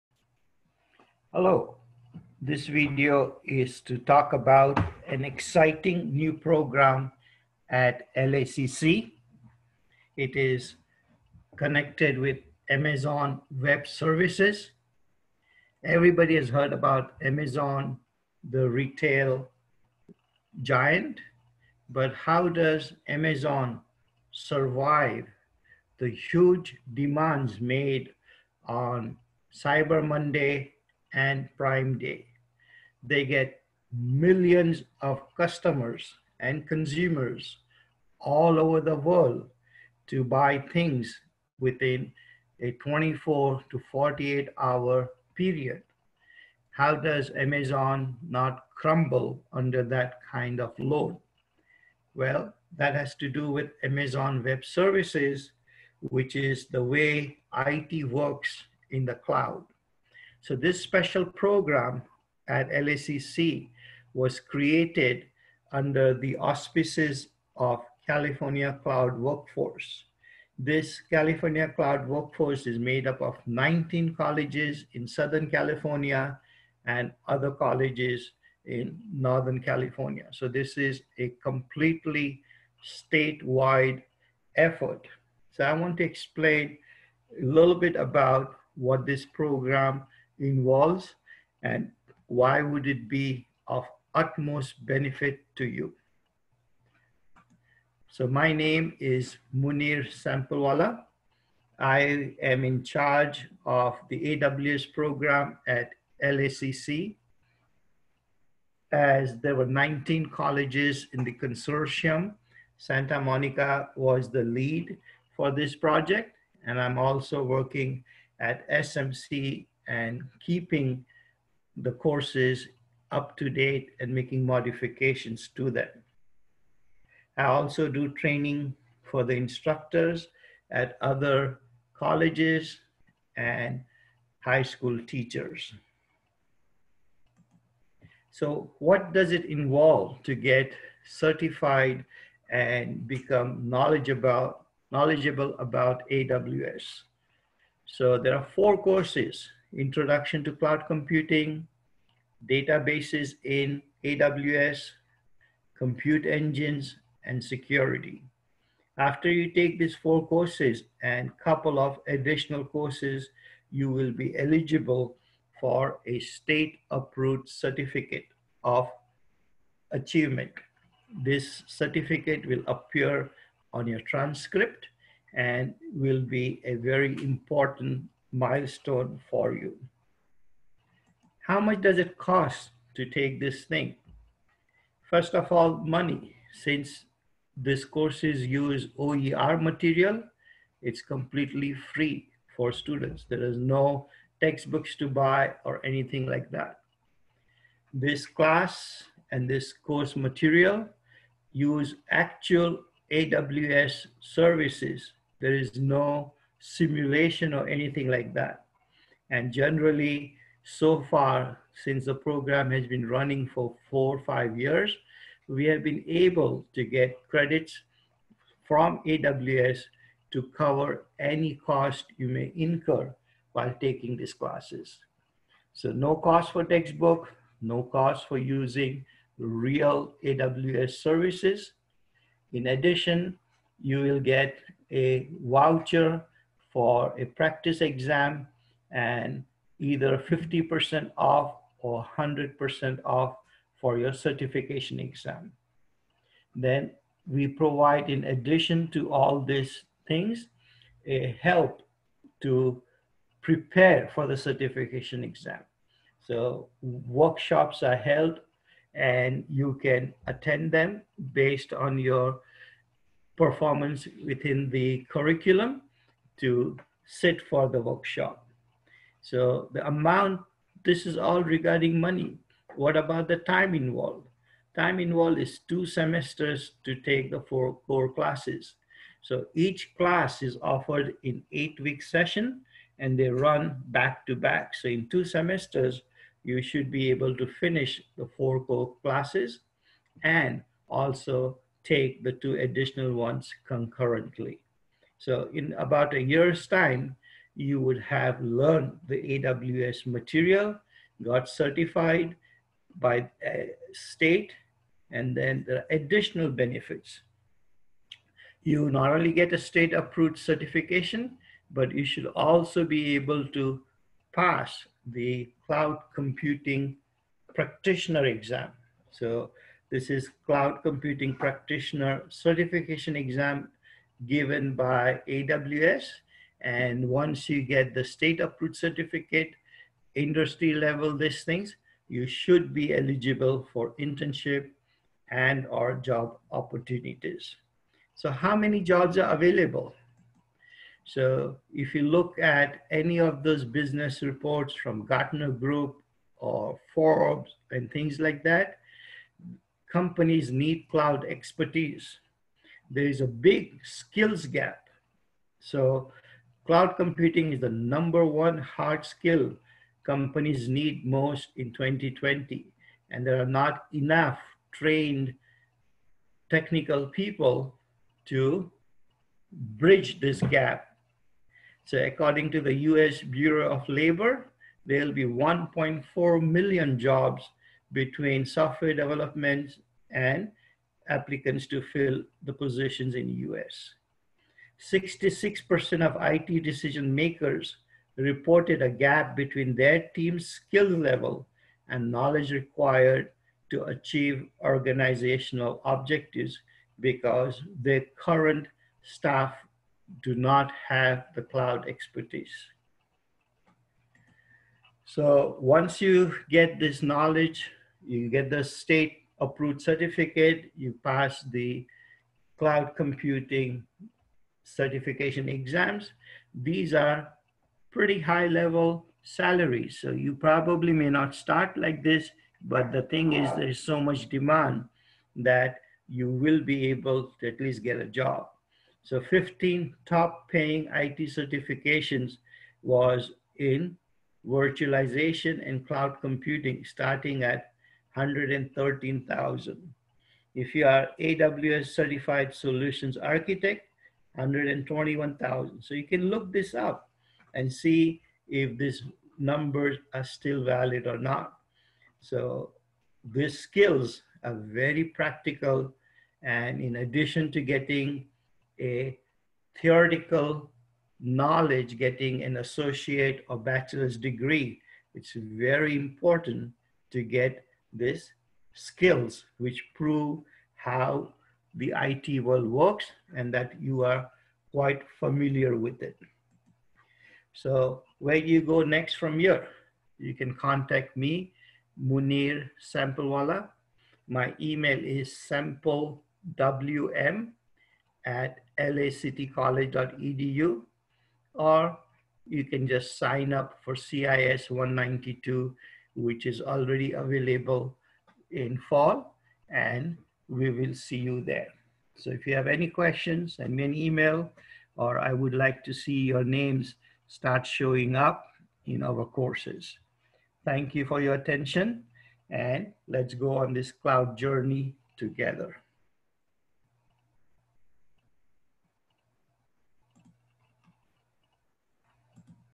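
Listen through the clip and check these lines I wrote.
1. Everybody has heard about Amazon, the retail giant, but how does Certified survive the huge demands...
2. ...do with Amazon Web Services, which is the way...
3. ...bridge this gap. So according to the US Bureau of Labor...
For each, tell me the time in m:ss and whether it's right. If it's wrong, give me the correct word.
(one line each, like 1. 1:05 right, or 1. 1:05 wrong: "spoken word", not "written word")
1. 0:15 wrong: "Amazon", not "Certified"
2. 0:53 right
3. 6:09 right.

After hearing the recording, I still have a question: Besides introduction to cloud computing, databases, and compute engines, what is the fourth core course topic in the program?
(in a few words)
Security.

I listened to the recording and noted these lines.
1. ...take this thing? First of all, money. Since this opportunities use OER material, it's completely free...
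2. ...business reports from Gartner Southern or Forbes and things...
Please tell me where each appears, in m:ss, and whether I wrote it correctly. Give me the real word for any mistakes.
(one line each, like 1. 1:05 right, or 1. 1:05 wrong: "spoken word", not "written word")
1. 3:03 wrong: "courses", not "opportunities"
2. 5:43 wrong: "Group", not "Southern".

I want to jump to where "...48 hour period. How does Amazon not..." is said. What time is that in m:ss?
0:43.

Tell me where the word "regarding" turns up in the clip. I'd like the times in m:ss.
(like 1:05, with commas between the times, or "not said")
4:31.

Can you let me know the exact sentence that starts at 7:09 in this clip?
So 15 top paying IT certifications was in virtualization and cloud computing starting at 113,000.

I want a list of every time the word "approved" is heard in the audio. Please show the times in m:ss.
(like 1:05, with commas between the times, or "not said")
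2:46, 5:09, 5:28, 6:49.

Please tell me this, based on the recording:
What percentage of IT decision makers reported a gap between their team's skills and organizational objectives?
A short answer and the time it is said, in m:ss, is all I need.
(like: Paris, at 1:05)
66%, at 6:24.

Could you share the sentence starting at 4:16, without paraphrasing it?
So workshops are held and you can attend them based on your performance within the curriculum to sit for the workshop.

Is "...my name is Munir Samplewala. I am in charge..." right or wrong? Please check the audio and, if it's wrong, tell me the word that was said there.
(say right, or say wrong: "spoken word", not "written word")
right.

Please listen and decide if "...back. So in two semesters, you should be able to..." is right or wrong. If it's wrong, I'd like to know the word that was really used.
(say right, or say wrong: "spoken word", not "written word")
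right.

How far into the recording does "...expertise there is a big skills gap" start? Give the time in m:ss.
5:51.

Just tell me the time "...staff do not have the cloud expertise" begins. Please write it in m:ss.
6:39.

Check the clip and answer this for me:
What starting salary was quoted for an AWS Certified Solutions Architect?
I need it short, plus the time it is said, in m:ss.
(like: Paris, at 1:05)
$121,000, at 7:24.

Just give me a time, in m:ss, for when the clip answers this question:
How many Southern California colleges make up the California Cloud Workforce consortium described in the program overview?
1:13.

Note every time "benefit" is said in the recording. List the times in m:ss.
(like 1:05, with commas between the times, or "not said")
1:34, 5:06.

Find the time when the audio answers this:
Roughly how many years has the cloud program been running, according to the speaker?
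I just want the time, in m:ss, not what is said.
3:33.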